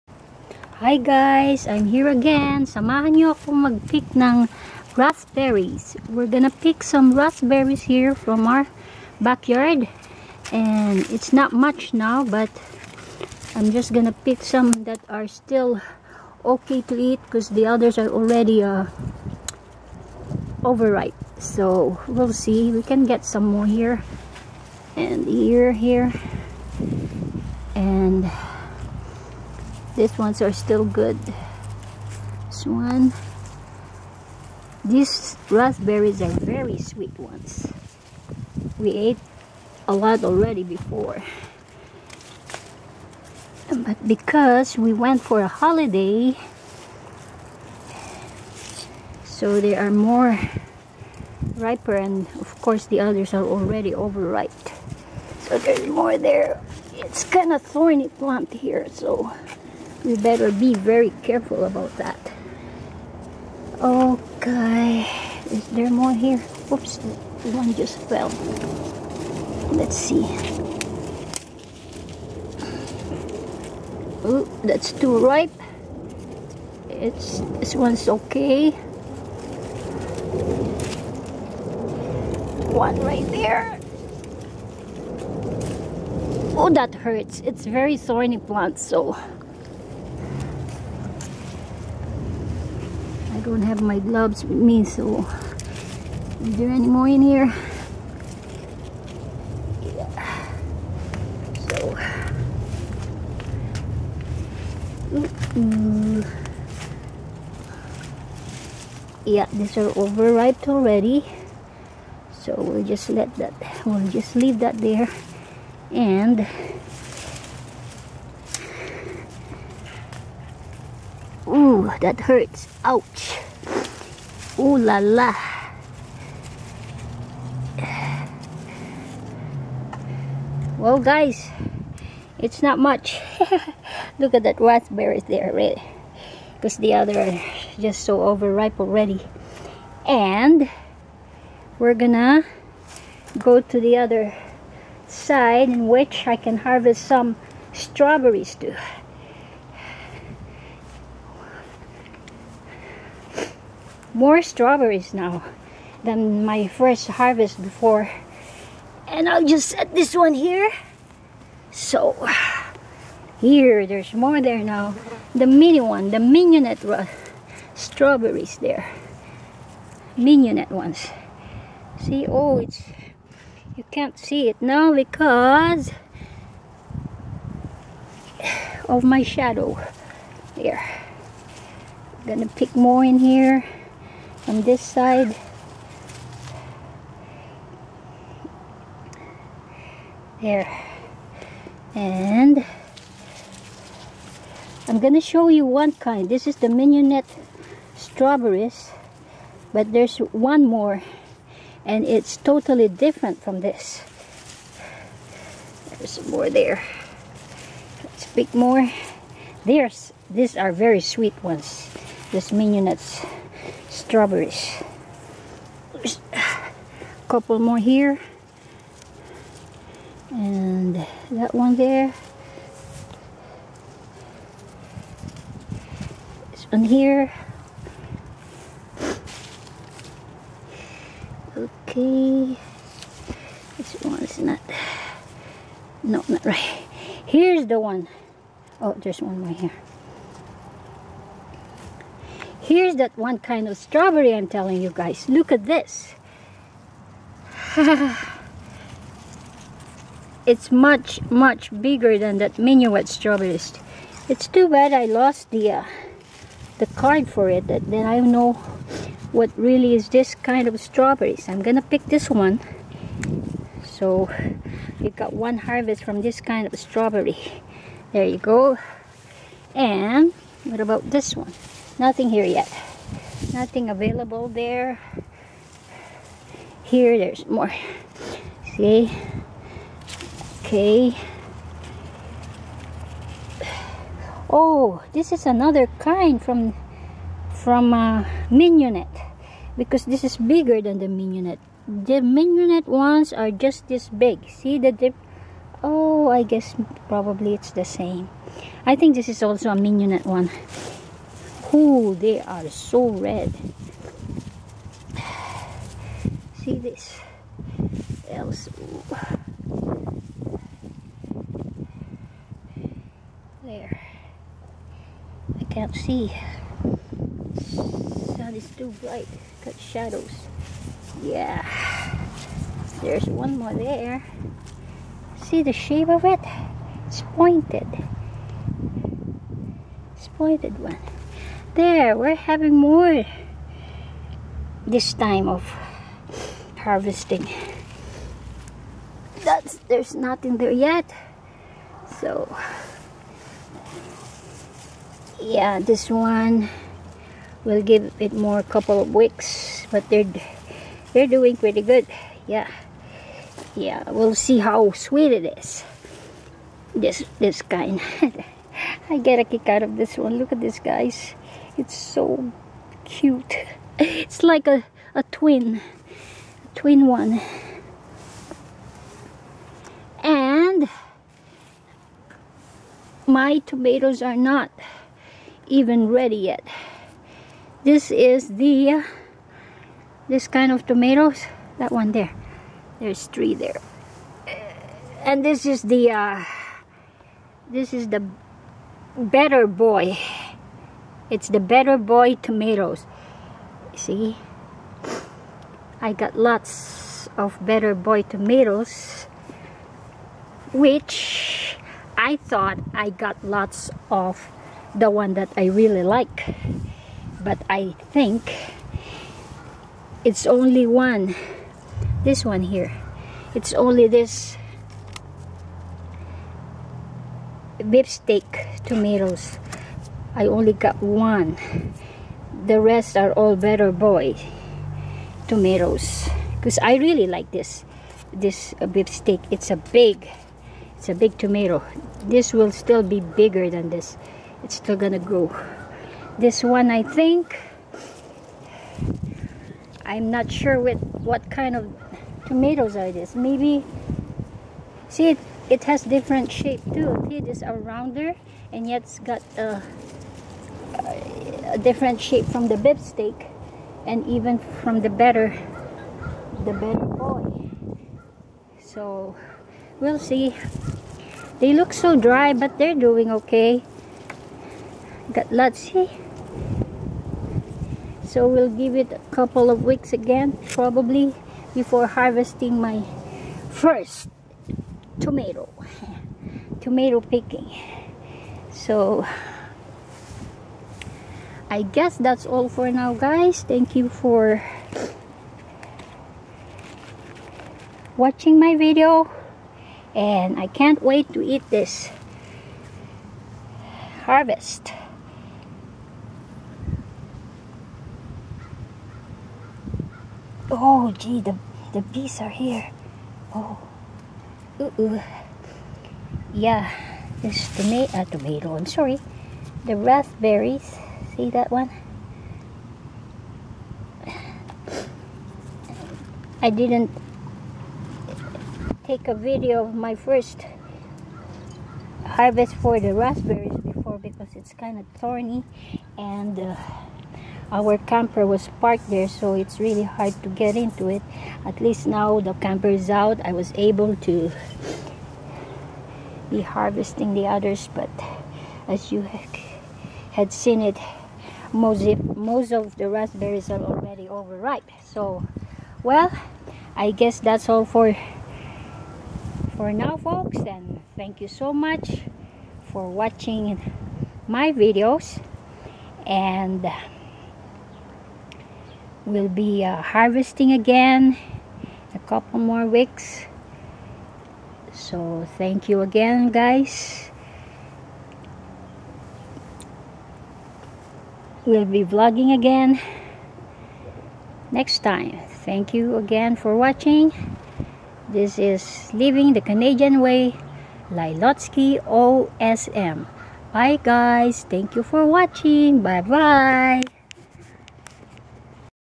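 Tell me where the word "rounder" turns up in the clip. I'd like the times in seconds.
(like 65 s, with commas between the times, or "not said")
447 s.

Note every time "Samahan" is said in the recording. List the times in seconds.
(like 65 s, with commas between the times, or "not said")
2 s.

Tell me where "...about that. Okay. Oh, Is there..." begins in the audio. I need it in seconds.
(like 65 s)
61 s.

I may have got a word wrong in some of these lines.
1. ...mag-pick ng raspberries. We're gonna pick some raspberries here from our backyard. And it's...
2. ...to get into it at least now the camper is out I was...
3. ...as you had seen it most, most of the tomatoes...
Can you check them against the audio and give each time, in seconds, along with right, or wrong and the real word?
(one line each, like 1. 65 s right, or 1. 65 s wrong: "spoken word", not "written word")
1. 3 s right
2. 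530 s right
3. 538 s wrong: "raspberries", not "tomatoes".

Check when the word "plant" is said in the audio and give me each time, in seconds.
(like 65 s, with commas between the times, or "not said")
58 s, 88 s.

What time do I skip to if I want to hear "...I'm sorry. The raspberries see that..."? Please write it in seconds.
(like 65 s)
508 s.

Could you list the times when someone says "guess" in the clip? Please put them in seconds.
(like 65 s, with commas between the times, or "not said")
296 s, 481 s, 547 s.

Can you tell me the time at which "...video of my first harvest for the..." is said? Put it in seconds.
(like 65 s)
519 s.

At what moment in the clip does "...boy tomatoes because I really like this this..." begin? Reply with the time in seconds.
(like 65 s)
423 s.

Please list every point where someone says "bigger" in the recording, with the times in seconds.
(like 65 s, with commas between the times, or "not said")
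251 s, 290 s, 433 s.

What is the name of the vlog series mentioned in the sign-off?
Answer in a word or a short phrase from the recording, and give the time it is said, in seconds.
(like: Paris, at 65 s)
Living the Canadian Way, at 579 s.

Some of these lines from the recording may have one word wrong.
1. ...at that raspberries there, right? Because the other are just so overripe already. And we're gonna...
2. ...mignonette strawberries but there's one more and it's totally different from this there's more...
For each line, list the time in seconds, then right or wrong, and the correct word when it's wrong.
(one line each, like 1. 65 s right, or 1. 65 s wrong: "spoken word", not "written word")
1. 134 s right
2. 196 s right.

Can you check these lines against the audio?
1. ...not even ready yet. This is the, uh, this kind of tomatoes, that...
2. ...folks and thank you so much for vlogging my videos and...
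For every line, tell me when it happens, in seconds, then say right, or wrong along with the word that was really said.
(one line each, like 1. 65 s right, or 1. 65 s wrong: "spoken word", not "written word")
1. 374 s right
2. 550 s wrong: "watching", not "vlogging".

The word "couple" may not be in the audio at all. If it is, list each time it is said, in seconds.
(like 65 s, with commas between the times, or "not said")
217 s, 348 s, 469 s, 562 s.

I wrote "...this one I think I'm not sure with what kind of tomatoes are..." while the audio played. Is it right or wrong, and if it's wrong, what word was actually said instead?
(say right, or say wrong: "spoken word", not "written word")
right.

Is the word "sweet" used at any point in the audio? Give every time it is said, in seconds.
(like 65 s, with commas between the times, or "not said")
36 s, 210 s, 354 s.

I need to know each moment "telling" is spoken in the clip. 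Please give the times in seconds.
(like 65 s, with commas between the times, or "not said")
244 s.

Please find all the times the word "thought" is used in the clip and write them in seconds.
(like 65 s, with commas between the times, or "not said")
402 s.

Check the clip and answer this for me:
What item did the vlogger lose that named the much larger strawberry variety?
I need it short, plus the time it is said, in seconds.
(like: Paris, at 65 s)
The card, at 256 s.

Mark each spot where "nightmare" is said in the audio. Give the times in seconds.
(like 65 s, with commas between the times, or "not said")
not said.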